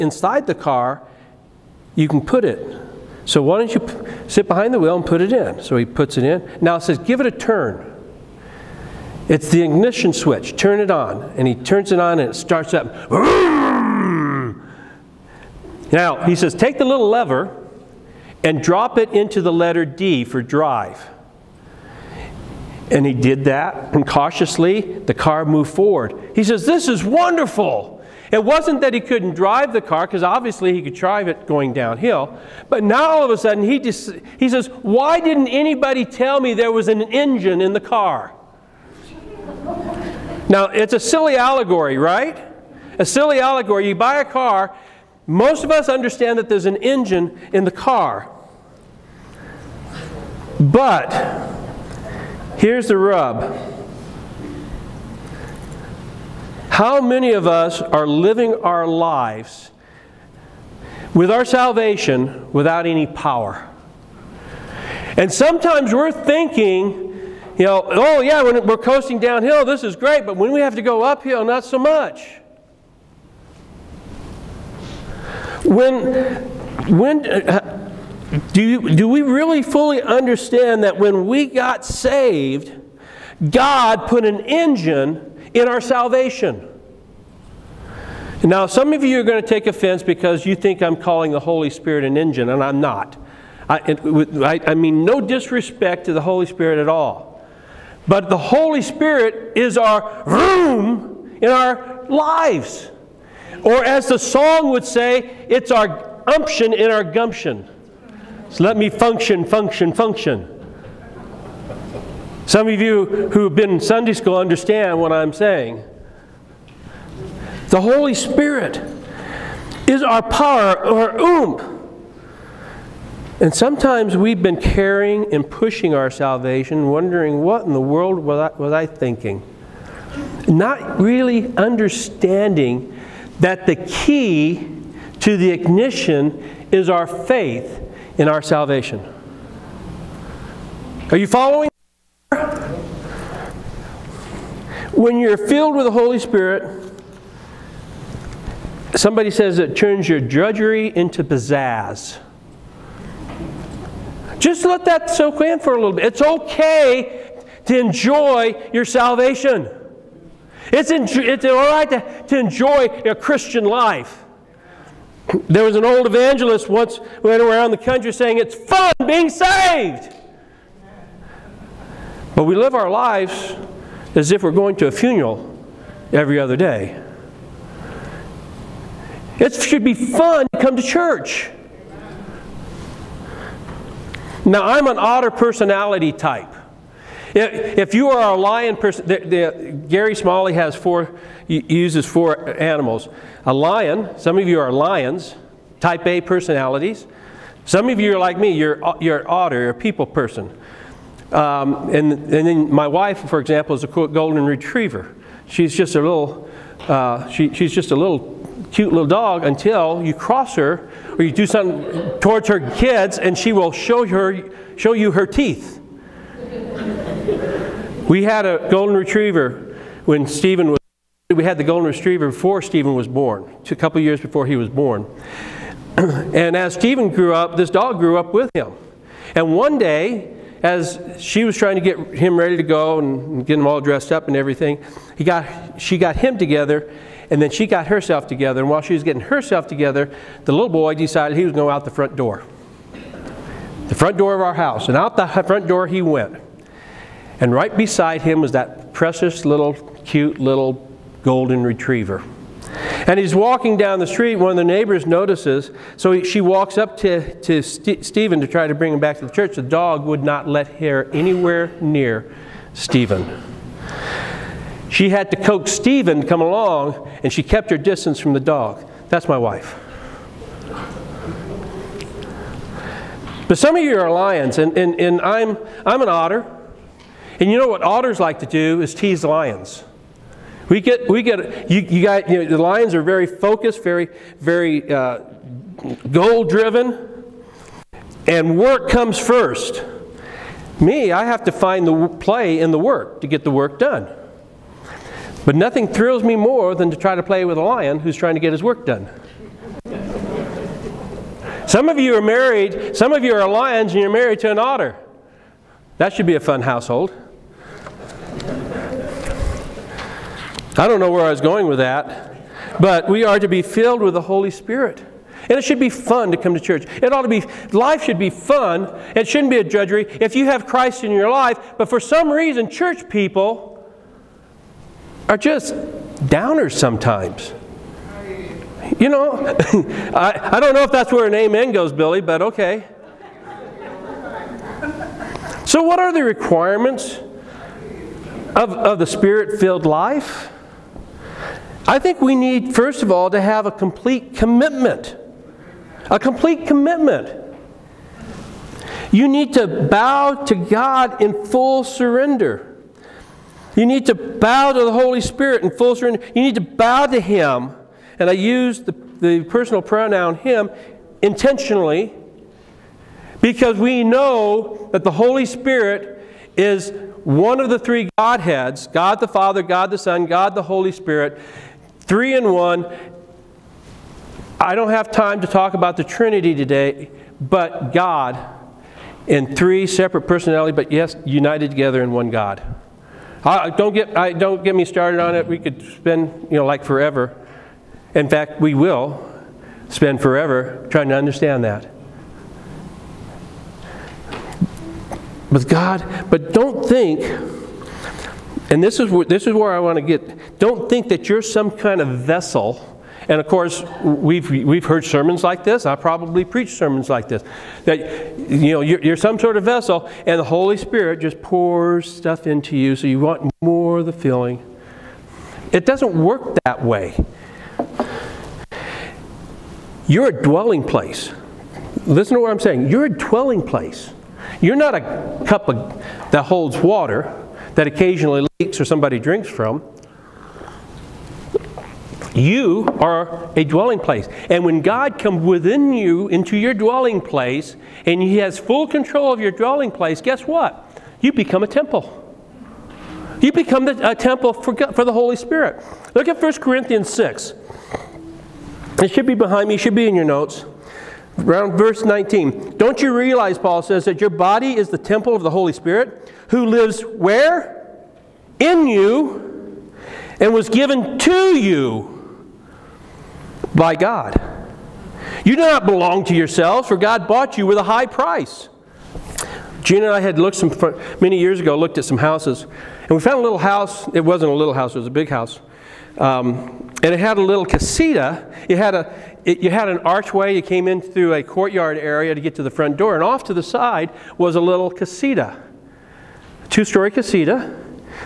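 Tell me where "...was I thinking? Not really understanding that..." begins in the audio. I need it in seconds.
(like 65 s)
128 s.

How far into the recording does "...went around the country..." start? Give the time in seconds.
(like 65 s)
167 s.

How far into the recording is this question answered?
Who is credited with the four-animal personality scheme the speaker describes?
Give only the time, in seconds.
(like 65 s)
189 s.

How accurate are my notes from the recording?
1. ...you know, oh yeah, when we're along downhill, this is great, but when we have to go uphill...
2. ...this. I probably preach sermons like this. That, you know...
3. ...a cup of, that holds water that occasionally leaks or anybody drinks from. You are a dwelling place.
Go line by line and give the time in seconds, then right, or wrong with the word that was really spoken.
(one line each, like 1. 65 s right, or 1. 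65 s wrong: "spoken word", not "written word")
1. 67 s wrong: "coasting", not "along"
2. 405 s right
3. 424 s wrong: "somebody", not "anybody".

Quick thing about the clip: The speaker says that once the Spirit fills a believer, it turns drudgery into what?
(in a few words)
Pizzazz.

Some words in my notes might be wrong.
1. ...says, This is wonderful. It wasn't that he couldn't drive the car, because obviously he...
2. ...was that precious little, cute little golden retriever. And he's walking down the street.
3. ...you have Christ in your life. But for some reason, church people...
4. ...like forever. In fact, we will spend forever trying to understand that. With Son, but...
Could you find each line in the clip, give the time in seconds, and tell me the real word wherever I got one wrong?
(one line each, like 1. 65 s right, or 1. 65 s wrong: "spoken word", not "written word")
1. 26 s right
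2. 248 s right
3. 320 s right
4. 386 s wrong: "God", not "Son".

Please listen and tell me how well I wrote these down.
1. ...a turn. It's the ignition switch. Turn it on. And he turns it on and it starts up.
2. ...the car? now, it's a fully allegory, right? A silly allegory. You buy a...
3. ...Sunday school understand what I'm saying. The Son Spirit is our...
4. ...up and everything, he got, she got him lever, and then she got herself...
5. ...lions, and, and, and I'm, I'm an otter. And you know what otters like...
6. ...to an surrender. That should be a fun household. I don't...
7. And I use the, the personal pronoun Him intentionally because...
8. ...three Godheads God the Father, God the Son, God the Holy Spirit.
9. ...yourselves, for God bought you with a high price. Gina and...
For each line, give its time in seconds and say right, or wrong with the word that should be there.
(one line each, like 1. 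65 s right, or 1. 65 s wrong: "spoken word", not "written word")
1. 7 s right
2. 37 s wrong: "silly", not "fully"
3. 113 s wrong: "Holy", not "Son"
4. 234 s wrong: "together", not "lever"
5. 274 s right
6. 304 s wrong: "otter", not "surrender"
7. 358 s right
8. 367 s right
9. 466 s right.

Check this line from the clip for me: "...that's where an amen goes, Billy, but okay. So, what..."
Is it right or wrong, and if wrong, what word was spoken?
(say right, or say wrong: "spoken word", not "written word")
right.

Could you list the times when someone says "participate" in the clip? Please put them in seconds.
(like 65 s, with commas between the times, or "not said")
not said.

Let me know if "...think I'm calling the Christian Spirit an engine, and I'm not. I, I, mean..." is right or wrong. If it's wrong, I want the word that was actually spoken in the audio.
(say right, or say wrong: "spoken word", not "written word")
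wrong: "Holy", not "Christian".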